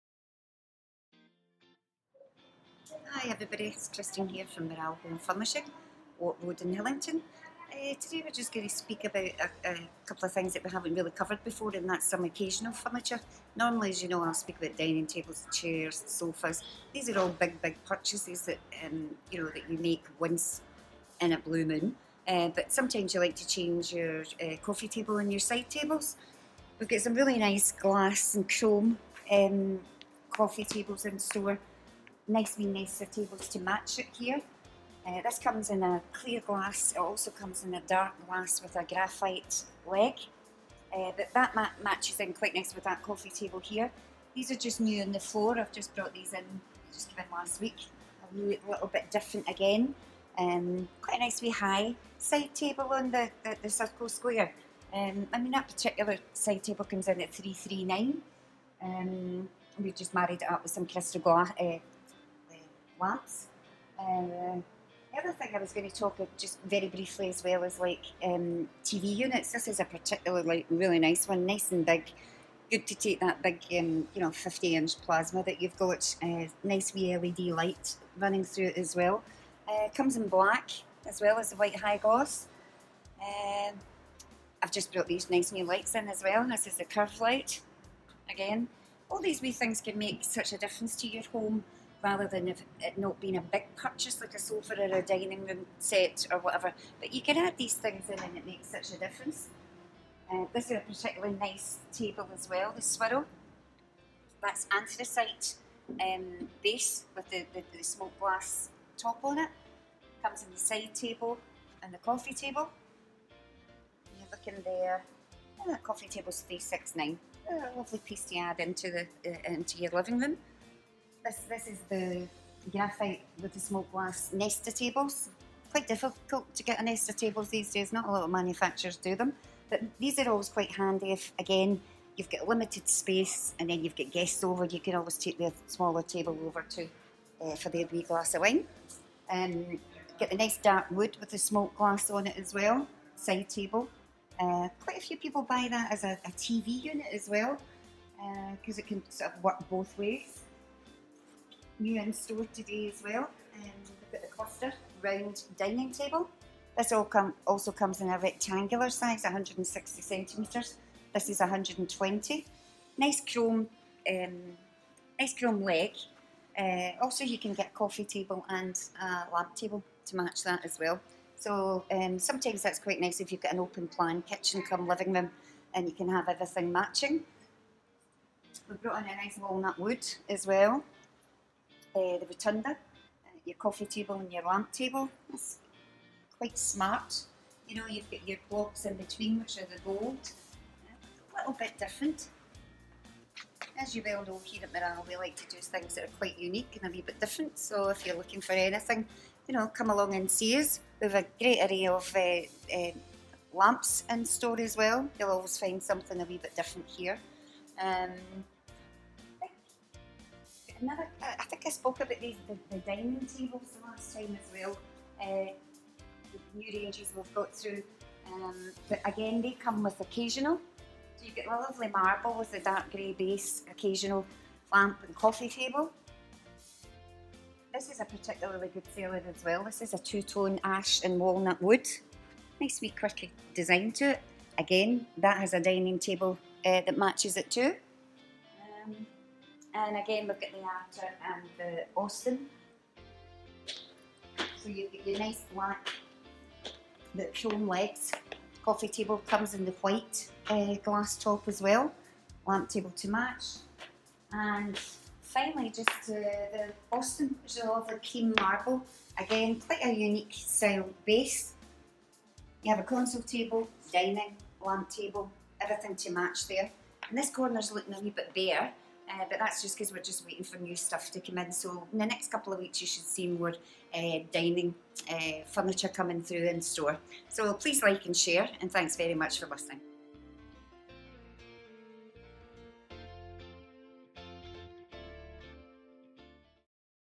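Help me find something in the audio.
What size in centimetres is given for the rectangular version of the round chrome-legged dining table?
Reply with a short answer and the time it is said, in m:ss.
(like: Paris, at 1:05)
160 centimetres, at 2:39.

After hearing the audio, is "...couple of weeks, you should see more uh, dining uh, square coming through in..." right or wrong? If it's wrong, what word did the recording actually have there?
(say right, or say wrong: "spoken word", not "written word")
wrong: "furniture", not "square".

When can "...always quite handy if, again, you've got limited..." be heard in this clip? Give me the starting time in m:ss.
2:10.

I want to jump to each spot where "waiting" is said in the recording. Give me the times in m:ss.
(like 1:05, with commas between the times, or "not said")
4:30.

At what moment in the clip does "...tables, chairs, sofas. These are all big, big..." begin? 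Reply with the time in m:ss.
0:15.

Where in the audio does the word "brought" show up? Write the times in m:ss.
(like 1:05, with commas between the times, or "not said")
0:45, 1:24, 2:58.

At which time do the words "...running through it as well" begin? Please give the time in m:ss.
1:18.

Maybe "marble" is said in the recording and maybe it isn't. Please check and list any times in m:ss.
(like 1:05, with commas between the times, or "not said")
3:41, 4:18.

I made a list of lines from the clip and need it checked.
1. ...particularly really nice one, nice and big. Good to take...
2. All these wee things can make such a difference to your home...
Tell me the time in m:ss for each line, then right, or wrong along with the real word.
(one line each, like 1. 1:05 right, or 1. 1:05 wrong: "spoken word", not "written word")
1. 1:09 right
2. 1:29 right.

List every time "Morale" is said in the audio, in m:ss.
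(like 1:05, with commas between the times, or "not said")
0:04, 3:14.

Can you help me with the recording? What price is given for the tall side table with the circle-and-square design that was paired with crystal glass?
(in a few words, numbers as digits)
339.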